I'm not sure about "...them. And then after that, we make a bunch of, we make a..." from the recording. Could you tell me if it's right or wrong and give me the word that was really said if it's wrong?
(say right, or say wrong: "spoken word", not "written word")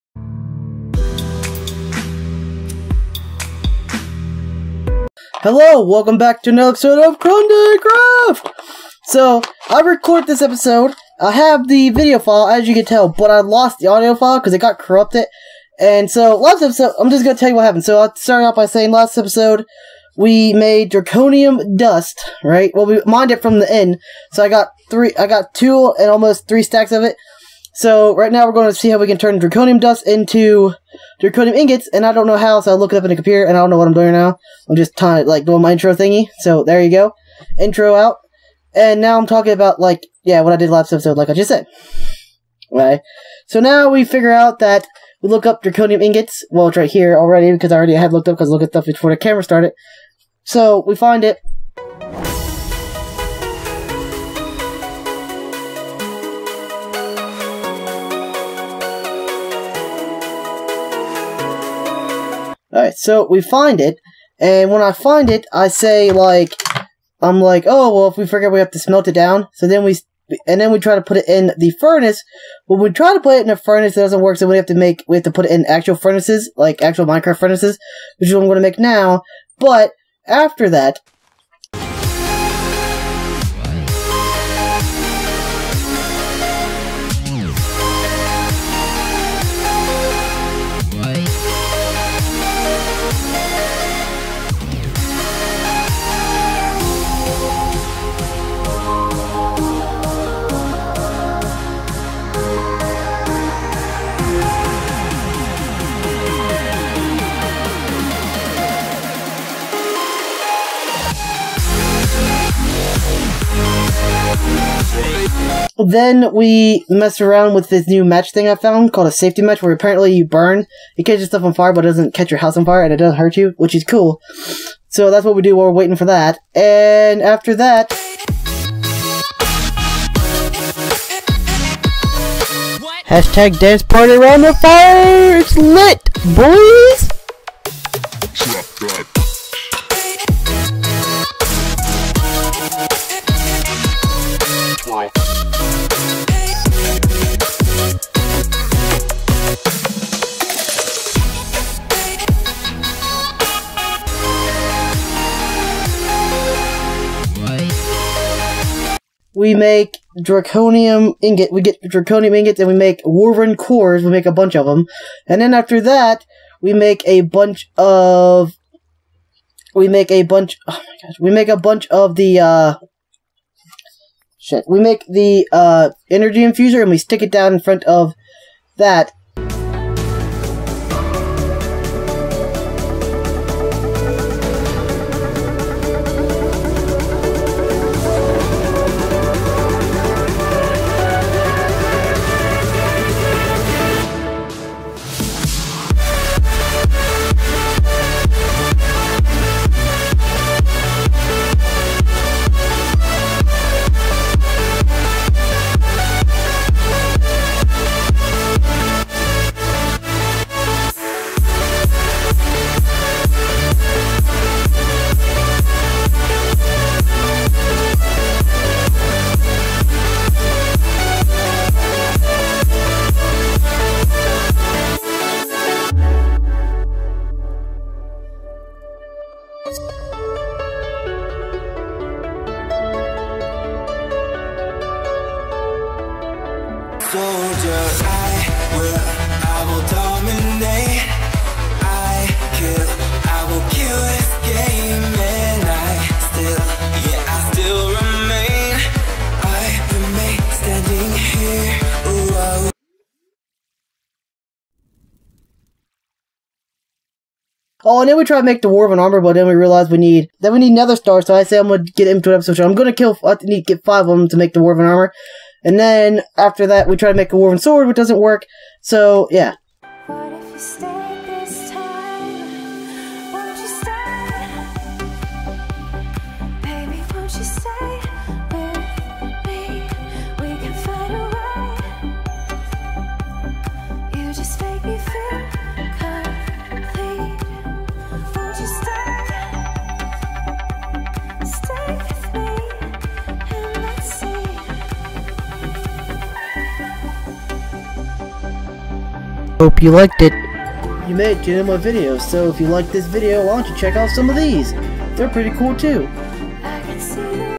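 right.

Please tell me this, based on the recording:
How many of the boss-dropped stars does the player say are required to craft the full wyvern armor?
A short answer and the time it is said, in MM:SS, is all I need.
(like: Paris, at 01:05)
5, at 04:23.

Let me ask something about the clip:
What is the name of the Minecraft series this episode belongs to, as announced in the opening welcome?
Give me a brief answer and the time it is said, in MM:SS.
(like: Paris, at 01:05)
Crundee Craft, at 00:07.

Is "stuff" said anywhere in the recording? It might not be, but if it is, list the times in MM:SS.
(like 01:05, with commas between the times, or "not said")
00:48, 02:01.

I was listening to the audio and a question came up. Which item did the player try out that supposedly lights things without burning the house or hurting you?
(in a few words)
Safety match.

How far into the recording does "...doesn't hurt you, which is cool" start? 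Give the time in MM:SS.
02:02.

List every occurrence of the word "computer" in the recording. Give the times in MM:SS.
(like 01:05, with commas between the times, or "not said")
00:33.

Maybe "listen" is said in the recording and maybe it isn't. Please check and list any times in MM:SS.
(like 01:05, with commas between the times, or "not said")
not said.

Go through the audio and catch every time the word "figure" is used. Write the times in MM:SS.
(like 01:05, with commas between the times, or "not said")
00:44.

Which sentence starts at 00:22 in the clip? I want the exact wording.
Well, we mined it from the end, so I got three, I got two and almost three stacks of it.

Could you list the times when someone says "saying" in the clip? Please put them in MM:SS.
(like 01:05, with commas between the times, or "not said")
00:18.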